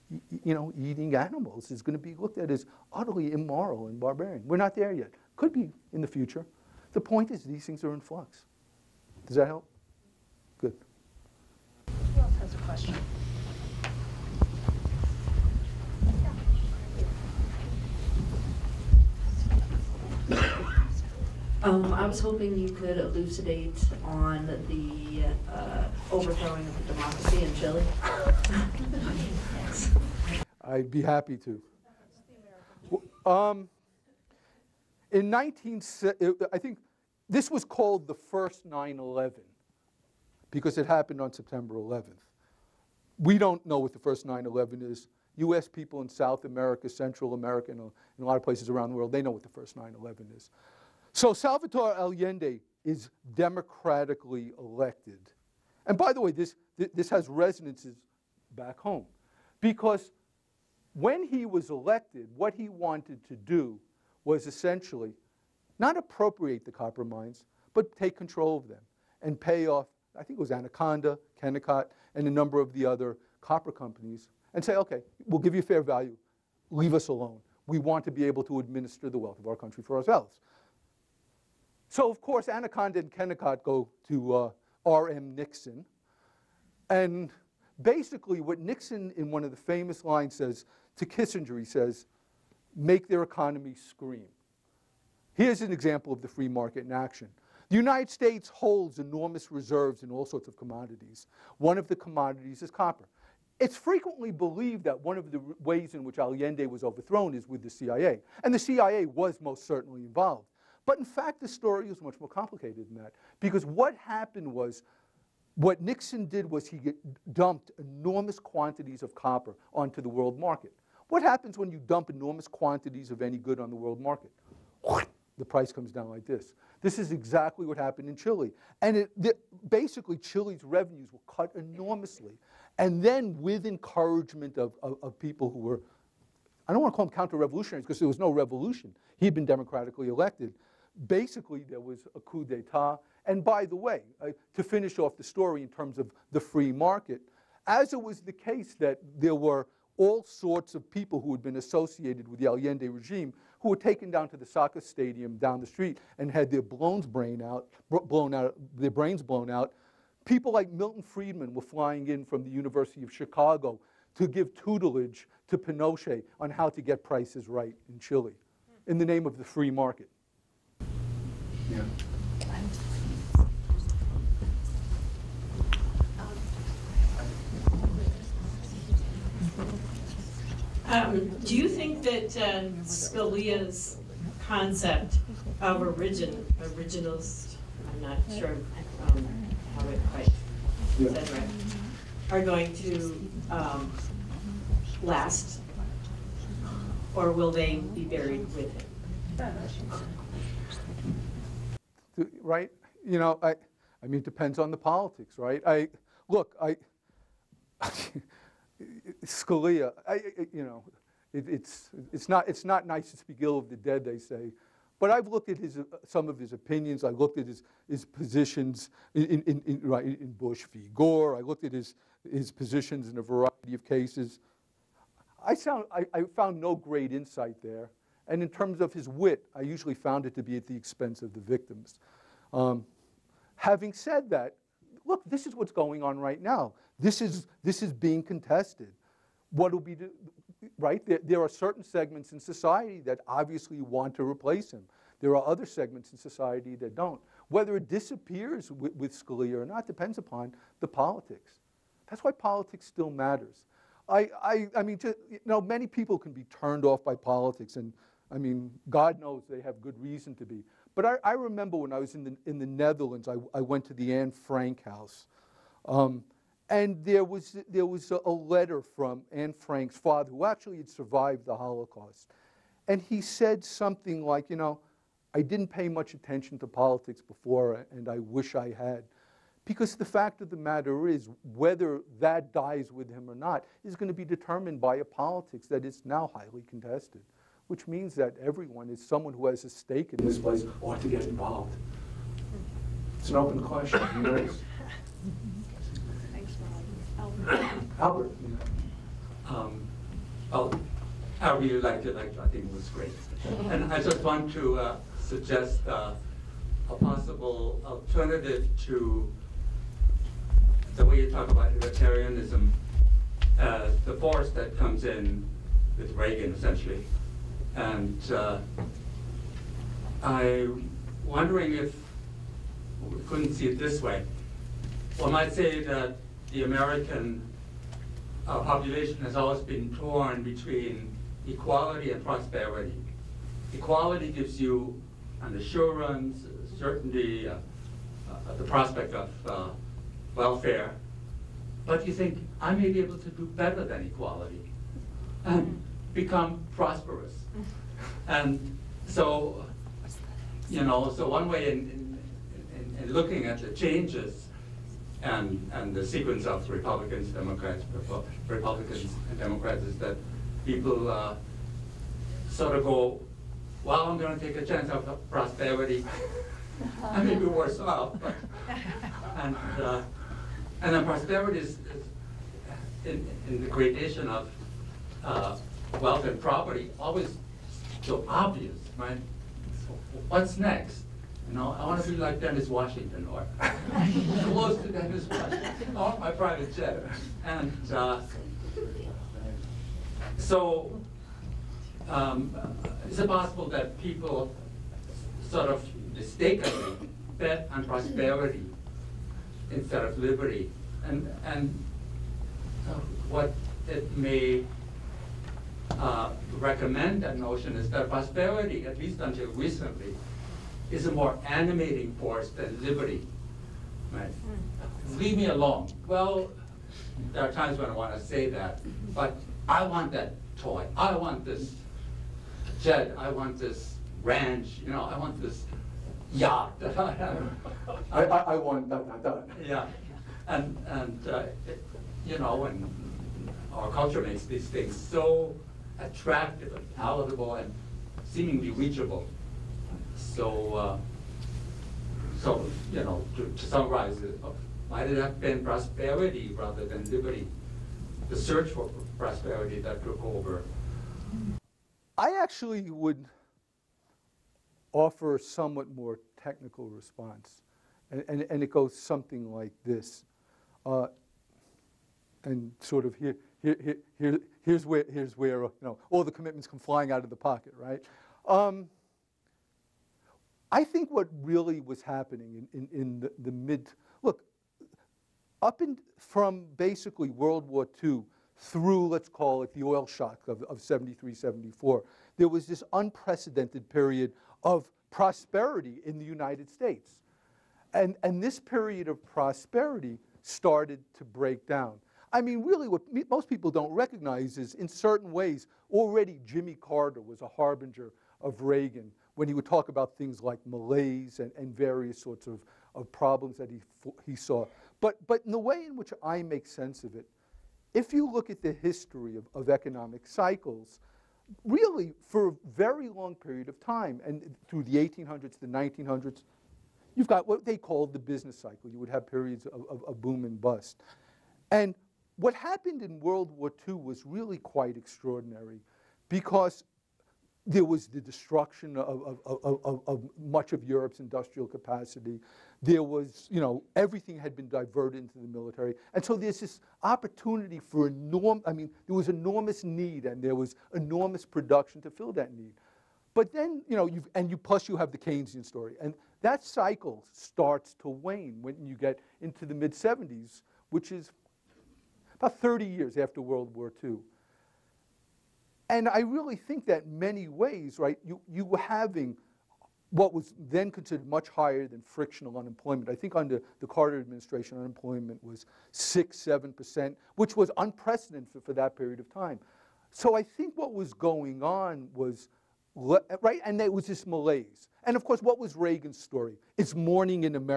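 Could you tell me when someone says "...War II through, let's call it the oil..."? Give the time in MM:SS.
07:57.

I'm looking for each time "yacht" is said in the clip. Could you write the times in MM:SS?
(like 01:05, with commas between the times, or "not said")
07:06.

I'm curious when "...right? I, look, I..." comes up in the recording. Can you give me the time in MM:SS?
03:25.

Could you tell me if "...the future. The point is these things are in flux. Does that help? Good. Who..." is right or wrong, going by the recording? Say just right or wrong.
right.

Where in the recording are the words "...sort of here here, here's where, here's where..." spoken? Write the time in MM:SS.
07:42.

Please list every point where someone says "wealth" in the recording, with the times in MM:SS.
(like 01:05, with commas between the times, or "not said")
01:19, 06:16.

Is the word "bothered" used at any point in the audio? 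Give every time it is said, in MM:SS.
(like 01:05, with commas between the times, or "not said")
not said.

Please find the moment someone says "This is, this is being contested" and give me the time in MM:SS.
03:56.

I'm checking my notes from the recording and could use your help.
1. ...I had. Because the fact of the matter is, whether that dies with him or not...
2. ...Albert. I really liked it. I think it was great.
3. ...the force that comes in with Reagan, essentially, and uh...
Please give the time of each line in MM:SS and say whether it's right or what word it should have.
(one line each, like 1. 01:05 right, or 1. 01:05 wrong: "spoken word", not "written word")
1. 04:38 right
2. 05:00 right
3. 05:14 right.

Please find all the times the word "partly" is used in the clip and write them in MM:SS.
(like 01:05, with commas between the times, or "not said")
not said.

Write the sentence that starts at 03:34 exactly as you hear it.
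But I've looked at his, some of his opinions.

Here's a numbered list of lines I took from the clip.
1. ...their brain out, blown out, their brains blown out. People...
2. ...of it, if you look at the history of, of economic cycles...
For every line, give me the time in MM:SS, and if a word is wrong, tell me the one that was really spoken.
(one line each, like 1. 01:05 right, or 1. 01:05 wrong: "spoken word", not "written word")
1. 02:36 right
2. 08:27 right.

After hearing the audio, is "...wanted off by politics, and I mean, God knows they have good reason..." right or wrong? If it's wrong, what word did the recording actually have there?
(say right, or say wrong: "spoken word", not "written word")
wrong: "turned", not "wanted".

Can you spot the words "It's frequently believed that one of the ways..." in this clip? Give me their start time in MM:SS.
01:43.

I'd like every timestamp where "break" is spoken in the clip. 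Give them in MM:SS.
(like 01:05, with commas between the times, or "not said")
08:11.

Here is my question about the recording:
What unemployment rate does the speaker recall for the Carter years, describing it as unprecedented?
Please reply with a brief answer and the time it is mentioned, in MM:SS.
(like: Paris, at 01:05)
6-7%, at 09:25.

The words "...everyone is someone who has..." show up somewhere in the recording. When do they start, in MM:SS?
04:48.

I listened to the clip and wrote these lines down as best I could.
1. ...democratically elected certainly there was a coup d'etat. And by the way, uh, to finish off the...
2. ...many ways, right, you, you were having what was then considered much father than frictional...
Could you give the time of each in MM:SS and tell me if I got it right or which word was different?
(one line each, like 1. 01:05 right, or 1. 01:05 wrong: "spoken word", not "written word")
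1. 02:19 wrong: "basically", not "certainly"
2. 09:17 wrong: "higher", not "father".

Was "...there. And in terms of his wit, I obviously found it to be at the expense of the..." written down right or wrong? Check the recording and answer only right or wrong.
wrong.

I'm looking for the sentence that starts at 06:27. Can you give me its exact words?
And uh, so um, is it possible that people sort of mistakenly bet on prosperity instead of liberty?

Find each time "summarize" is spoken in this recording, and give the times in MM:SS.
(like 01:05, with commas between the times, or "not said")
07:23.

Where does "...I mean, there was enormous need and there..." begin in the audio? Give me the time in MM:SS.
08:58.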